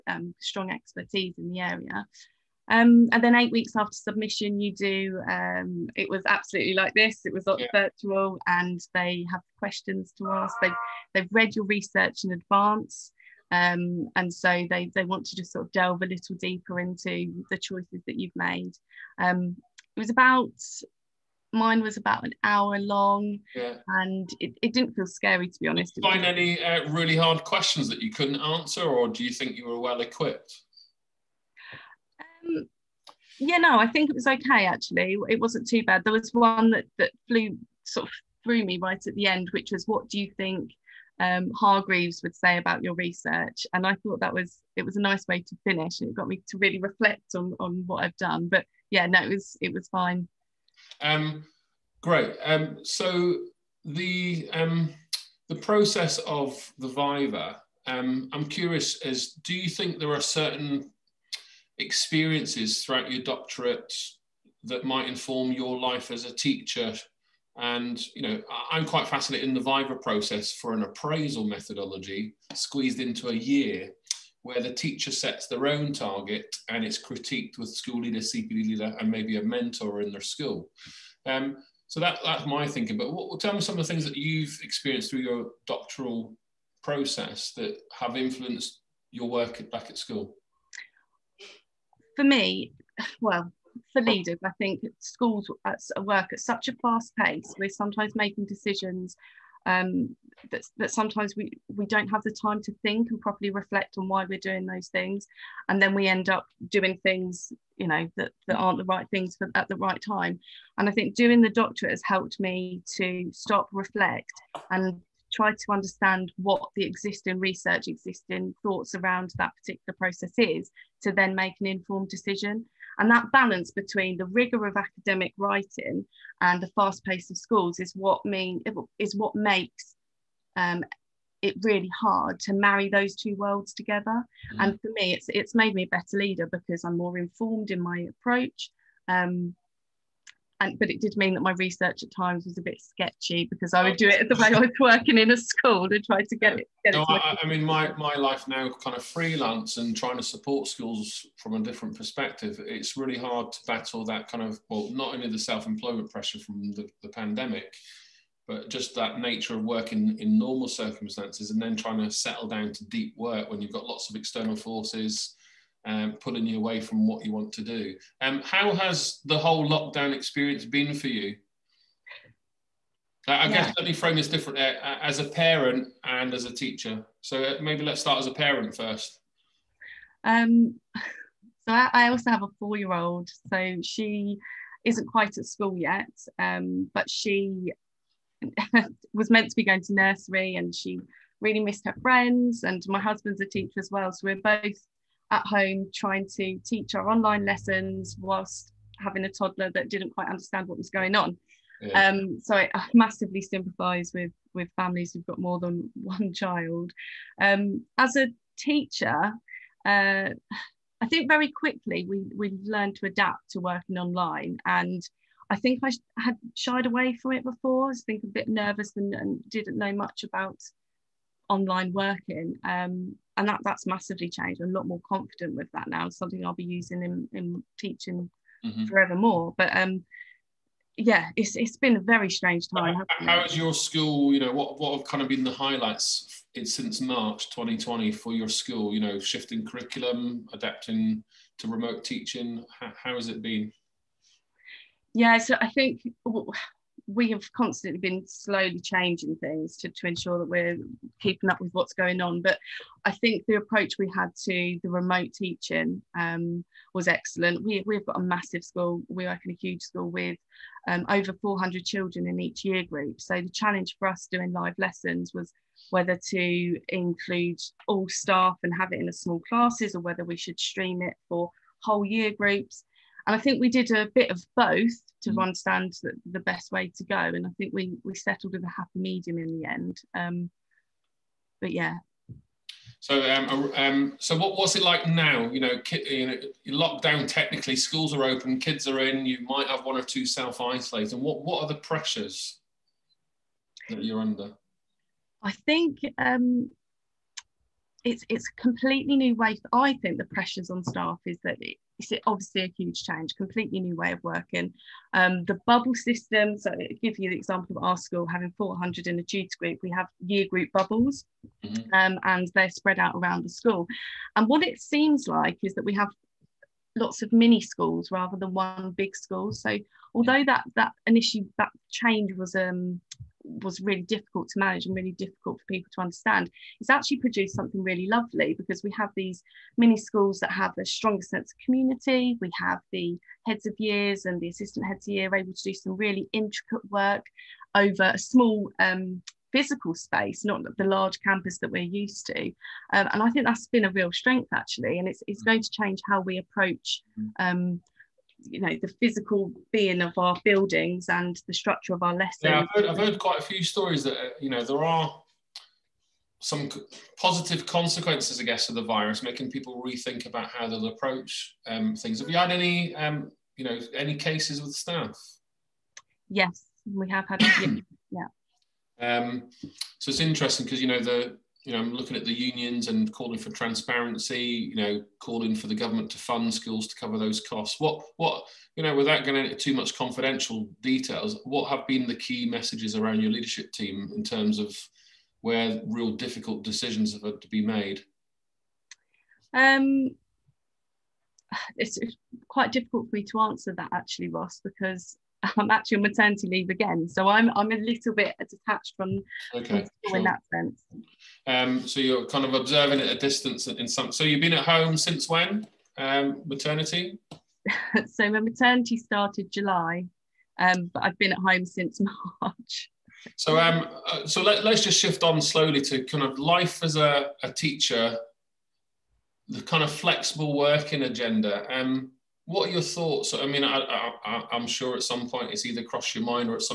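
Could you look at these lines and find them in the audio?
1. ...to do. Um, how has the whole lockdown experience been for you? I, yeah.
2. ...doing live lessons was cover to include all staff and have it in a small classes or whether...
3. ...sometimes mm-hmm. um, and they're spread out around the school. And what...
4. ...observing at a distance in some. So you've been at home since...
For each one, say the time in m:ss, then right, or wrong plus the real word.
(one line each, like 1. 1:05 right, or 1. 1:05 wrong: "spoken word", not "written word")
1. 2:47 right
2. 4:24 wrong: "whether", not "cover"
3. 5:10 wrong: "bubbles", not "sometimes"
4. 6:42 right.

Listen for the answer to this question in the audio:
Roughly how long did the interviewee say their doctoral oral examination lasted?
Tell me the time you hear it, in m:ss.
0:21.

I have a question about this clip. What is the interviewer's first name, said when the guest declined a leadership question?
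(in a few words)
Ross.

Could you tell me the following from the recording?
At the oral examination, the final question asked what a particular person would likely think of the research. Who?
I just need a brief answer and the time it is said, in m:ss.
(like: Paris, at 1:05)
Hargreaves, at 0:41.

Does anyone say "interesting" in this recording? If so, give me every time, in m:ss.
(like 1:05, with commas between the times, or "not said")
6:10.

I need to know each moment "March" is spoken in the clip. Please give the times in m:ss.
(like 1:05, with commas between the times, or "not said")
3:57, 6:52.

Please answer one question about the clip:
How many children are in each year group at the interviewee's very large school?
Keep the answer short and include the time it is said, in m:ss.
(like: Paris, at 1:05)
over 400, at 4:21.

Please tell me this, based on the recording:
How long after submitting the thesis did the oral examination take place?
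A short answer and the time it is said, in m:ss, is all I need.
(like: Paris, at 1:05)
8 weeks, at 0:03.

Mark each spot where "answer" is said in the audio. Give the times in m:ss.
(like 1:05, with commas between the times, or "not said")
0:28, 6:33.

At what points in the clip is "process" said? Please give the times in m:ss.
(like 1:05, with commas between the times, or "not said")
0:55, 1:09, 1:26, 1:59.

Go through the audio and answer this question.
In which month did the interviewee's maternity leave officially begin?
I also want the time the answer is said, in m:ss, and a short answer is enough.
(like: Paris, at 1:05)
July, at 6:49.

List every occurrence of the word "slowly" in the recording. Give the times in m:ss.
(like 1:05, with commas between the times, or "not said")
4:08, 6:55.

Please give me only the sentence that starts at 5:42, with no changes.
Um, and I think that's been a real strength actually, and it's it's mm.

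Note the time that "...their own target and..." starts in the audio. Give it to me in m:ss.
1:15.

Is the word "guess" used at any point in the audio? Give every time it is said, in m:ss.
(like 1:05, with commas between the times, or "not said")
2:53, 5:58.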